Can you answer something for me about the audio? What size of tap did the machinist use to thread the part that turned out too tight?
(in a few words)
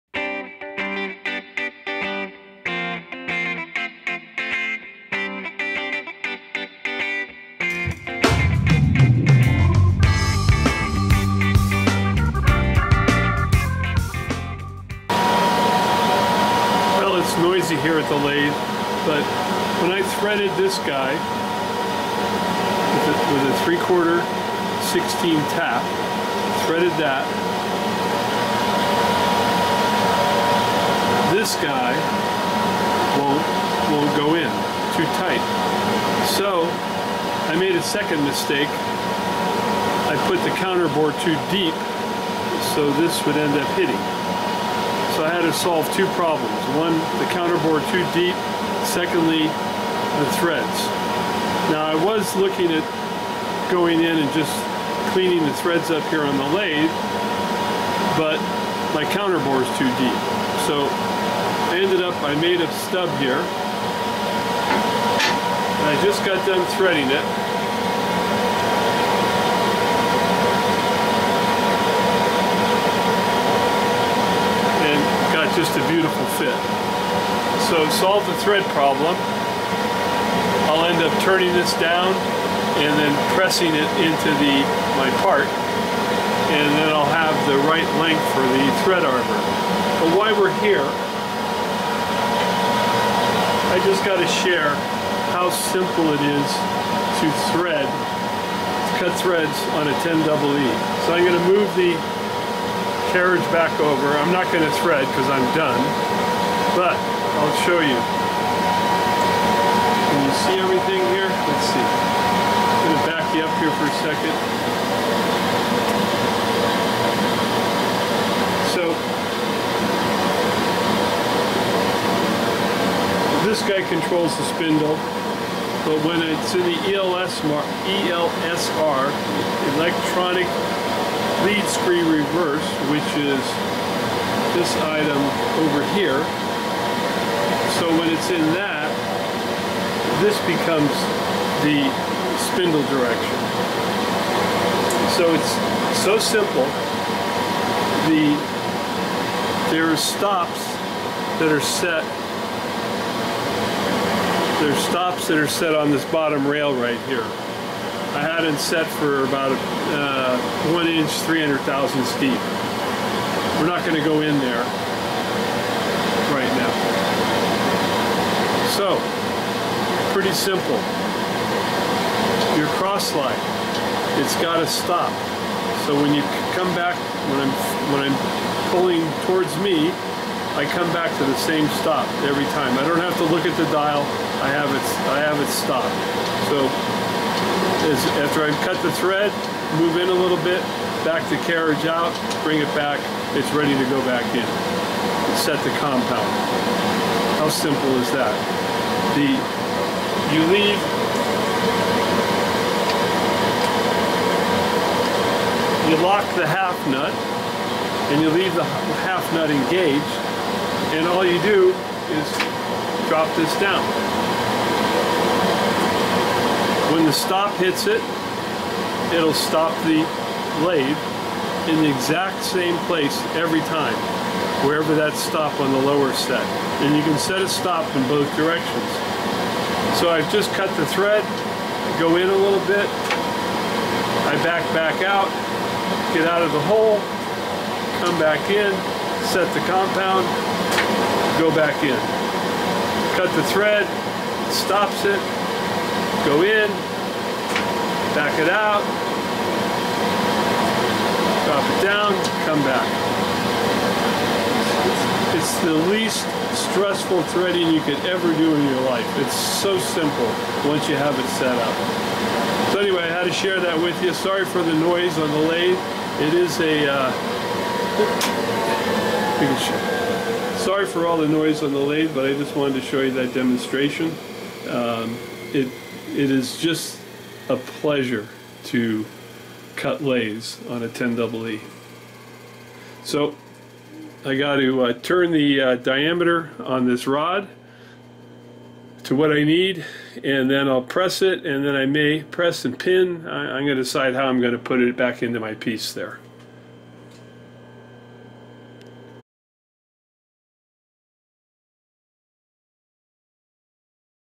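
3/4-16.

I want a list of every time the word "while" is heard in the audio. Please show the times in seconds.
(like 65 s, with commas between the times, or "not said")
90 s.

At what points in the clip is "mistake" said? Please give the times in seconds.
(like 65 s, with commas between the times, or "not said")
38 s.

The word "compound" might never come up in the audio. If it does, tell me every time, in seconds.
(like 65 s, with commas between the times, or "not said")
195 s, 239 s.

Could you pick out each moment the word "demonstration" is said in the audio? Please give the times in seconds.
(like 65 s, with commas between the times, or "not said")
273 s.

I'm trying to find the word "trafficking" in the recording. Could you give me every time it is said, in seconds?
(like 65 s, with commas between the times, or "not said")
not said.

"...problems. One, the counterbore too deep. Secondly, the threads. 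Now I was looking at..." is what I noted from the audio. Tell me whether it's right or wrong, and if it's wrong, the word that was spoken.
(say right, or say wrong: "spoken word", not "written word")
right.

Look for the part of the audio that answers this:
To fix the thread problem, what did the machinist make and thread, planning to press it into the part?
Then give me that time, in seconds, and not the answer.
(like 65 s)
62 s.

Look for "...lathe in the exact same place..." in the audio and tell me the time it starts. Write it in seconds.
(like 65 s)
220 s.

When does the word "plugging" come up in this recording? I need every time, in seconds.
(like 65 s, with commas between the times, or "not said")
not said.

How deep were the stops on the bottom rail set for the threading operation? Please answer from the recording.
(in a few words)
300 thousandths.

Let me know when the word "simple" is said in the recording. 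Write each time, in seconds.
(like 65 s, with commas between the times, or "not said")
95 s, 146 s, 170 s, 197 s, 259 s.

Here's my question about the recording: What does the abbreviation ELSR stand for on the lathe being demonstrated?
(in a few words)
electronic lead screw reverse.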